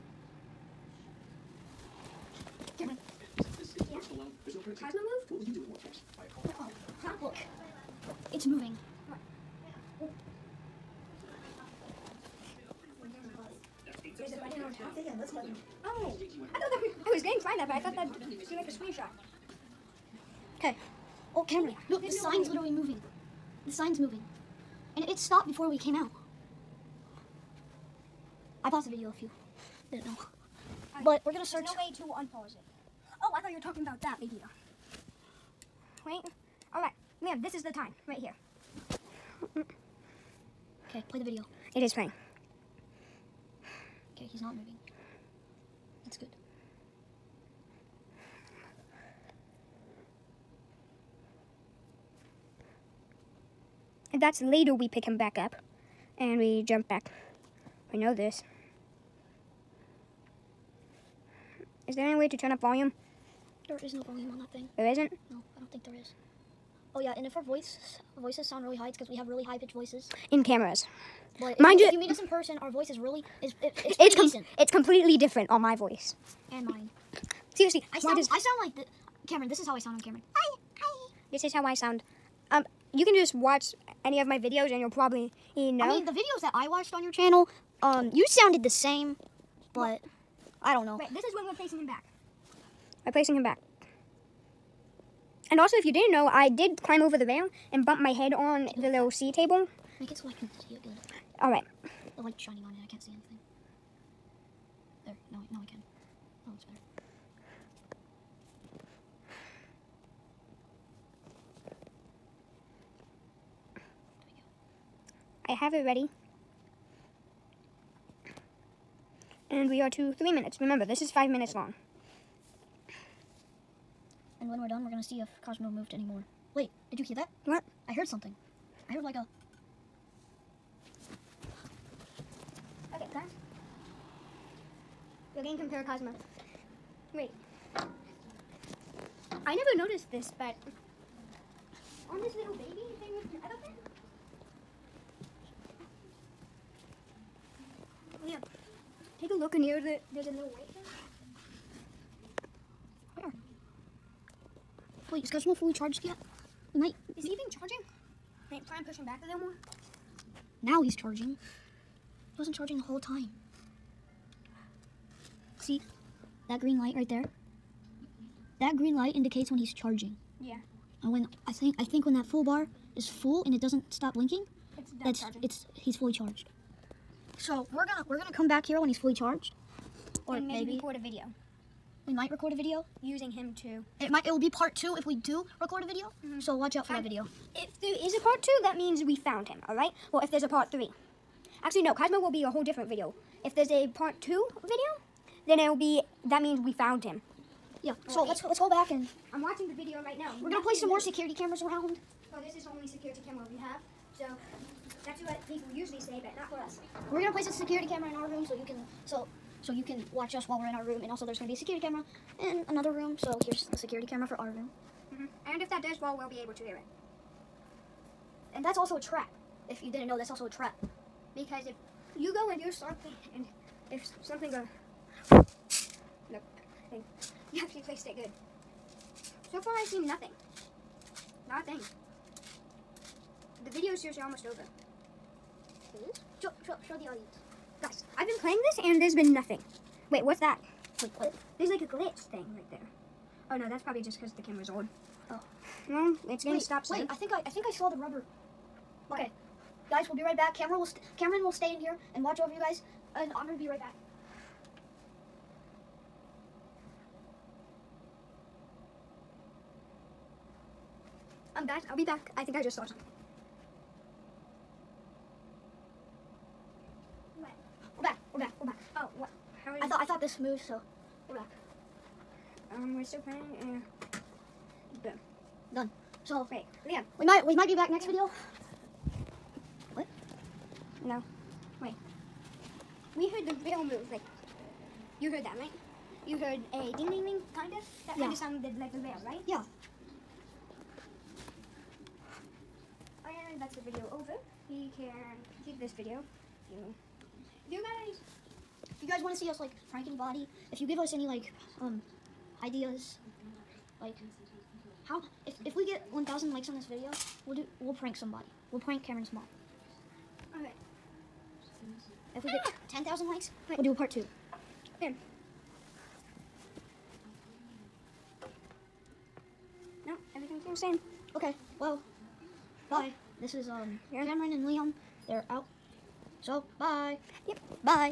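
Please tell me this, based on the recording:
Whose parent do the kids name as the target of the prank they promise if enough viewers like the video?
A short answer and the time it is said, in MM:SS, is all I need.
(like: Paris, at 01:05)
Cameron's mom, at 05:09.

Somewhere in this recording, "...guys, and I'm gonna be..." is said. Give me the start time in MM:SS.
04:12.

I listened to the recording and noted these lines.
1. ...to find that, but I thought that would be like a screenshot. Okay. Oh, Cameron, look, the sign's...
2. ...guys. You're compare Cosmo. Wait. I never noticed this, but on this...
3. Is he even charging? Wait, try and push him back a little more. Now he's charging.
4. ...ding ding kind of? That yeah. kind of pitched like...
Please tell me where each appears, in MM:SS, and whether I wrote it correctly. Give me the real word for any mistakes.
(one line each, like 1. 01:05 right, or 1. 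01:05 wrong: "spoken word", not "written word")
1. 00:17 right
2. 02:13 right
3. 02:37 right
4. 04:47 wrong: "sounded", not "pitched".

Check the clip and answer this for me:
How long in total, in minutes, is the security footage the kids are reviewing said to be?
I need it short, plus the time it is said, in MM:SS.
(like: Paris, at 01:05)
5 minutes, at 02:01.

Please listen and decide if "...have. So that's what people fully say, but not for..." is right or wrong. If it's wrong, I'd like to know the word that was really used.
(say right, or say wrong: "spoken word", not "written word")
wrong: "usually", not "fully".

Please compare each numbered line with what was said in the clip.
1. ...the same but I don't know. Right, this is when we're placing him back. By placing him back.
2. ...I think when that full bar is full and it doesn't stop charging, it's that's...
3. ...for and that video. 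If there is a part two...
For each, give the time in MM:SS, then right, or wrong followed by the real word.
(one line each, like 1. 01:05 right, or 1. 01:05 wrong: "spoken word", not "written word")
1. 01:28 right
2. 02:51 wrong: "blinking", not "charging"
3. 03:06 right.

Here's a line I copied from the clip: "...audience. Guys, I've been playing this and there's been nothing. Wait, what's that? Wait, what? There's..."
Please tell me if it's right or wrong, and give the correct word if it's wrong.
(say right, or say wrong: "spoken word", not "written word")
right.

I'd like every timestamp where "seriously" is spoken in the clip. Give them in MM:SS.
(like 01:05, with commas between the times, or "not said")
01:17, 03:54.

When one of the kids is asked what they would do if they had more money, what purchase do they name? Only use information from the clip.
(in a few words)
Buy a car.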